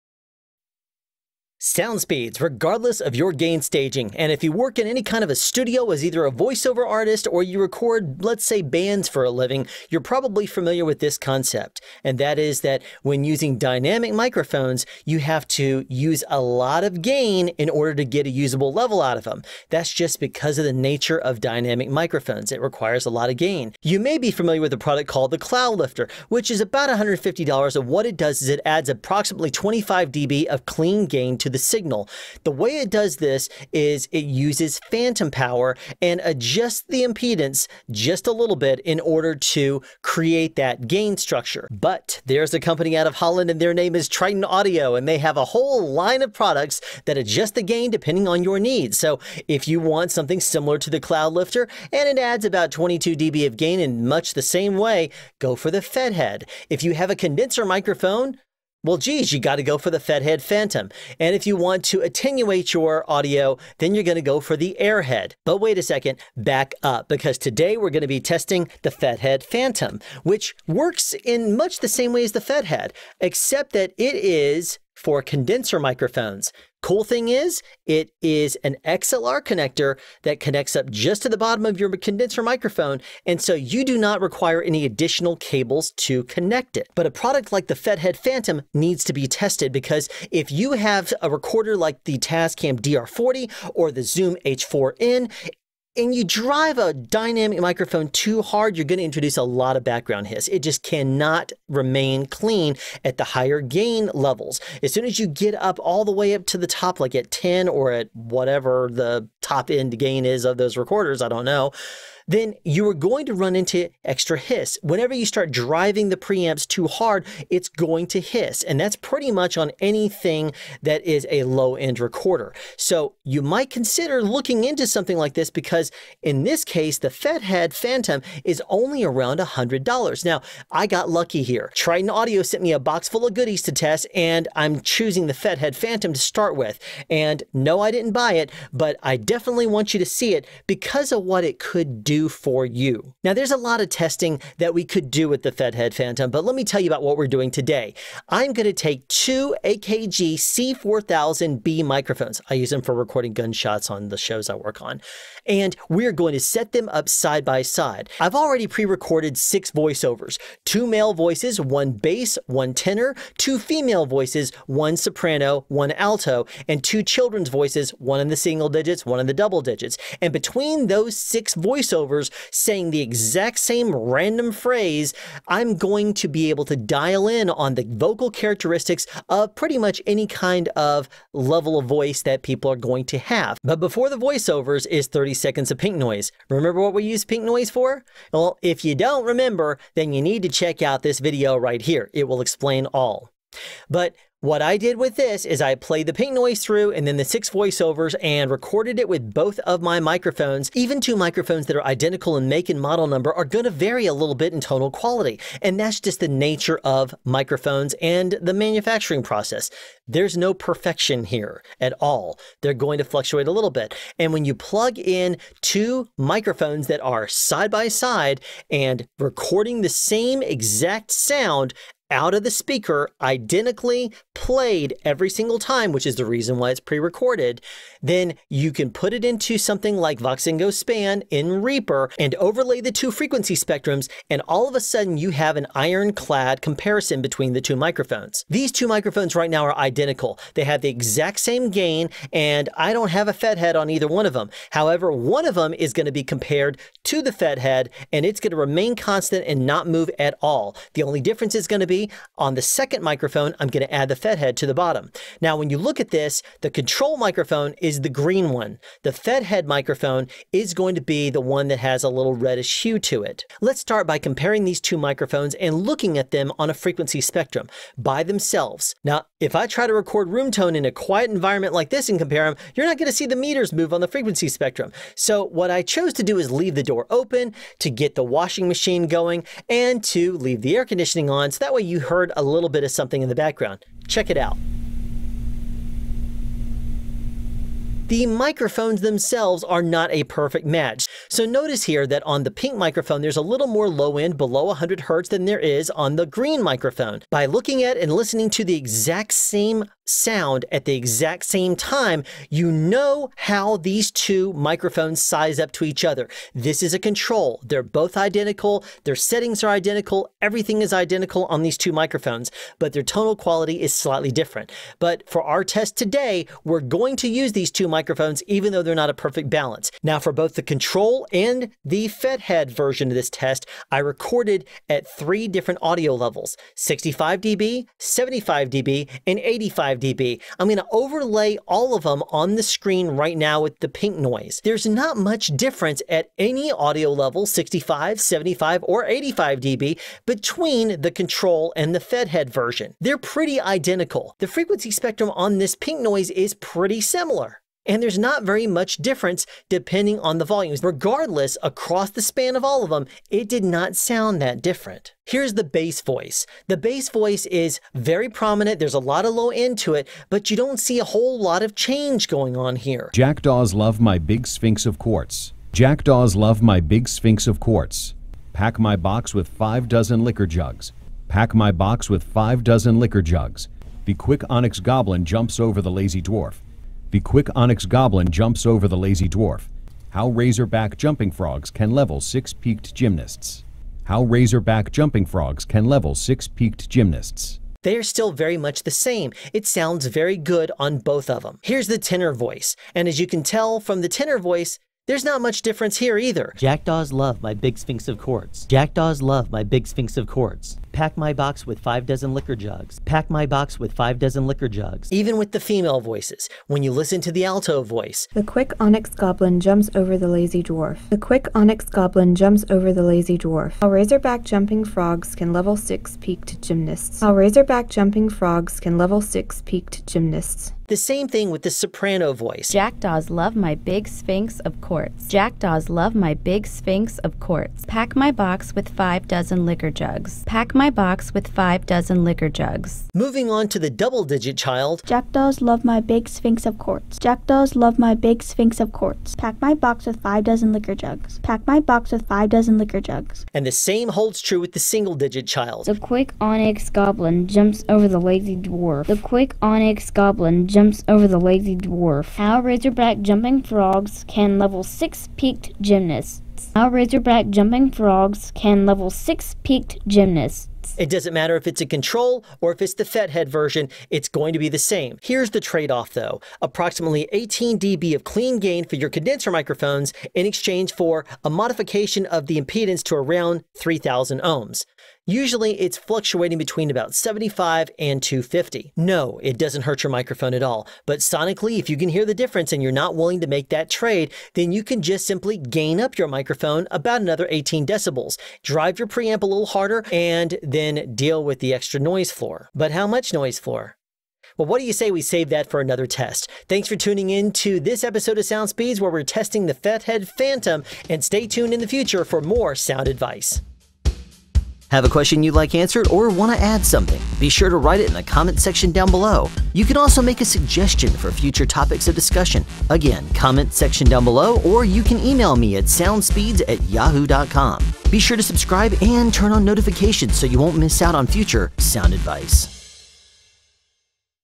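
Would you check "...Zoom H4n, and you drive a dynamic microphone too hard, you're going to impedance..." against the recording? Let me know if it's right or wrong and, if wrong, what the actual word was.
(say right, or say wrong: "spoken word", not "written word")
wrong: "introduce", not "impedance".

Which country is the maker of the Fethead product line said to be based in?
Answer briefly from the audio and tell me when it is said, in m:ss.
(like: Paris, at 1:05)
Holland, at 0:43.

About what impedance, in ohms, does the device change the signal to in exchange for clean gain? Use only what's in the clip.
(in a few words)
3000 ohms.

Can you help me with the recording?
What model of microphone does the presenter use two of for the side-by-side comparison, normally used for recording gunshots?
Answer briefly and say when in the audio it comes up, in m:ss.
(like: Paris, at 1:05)
AKG C4000B, at 2:29.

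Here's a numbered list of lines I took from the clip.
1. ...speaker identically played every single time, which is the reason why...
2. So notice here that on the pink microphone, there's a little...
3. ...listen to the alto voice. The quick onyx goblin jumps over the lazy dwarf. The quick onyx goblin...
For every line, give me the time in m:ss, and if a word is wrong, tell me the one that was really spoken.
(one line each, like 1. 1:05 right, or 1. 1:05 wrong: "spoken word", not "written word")
1. 3:42 right
2. 4:51 right
3. 6:46 right.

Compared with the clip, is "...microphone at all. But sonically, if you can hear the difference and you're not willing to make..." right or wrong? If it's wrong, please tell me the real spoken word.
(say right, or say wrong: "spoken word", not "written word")
right.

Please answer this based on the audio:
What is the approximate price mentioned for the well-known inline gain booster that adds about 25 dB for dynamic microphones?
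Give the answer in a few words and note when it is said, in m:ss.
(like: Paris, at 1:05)
$150, at 0:26.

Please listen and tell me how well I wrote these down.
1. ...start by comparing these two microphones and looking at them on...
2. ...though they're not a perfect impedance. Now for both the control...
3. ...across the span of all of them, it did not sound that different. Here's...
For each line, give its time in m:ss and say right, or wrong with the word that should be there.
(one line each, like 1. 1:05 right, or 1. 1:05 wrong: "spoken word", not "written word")
1. 4:23 right
2. 5:18 wrong: "balance", not "impedance"
3. 5:51 right.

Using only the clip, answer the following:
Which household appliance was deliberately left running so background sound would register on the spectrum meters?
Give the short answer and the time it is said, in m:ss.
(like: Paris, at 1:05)
washing machine, at 4:38.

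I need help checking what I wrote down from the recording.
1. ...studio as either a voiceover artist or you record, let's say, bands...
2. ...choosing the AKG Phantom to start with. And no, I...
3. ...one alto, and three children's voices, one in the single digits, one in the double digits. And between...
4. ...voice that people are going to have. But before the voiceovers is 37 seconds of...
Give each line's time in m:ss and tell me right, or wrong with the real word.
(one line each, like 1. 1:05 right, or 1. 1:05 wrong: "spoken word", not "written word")
1. 0:05 right
2. 2:14 wrong: "Fethead", not "AKG"
3. 2:45 wrong: "two", not "three"
4. 3:01 wrong: "30", not "37".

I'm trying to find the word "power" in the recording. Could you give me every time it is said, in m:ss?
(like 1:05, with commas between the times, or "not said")
0:35.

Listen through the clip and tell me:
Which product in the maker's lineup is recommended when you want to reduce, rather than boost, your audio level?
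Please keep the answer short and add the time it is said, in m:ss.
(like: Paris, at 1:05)
Airhead, at 1:04.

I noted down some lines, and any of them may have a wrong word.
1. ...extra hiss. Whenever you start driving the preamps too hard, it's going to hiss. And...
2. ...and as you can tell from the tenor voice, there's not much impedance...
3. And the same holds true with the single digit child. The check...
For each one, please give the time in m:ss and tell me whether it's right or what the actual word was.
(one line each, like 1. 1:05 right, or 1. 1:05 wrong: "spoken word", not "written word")
1. 1:54 right
2. 6:32 wrong: "difference", not "impedance"
3. 7:23 wrong: "quick", not "check".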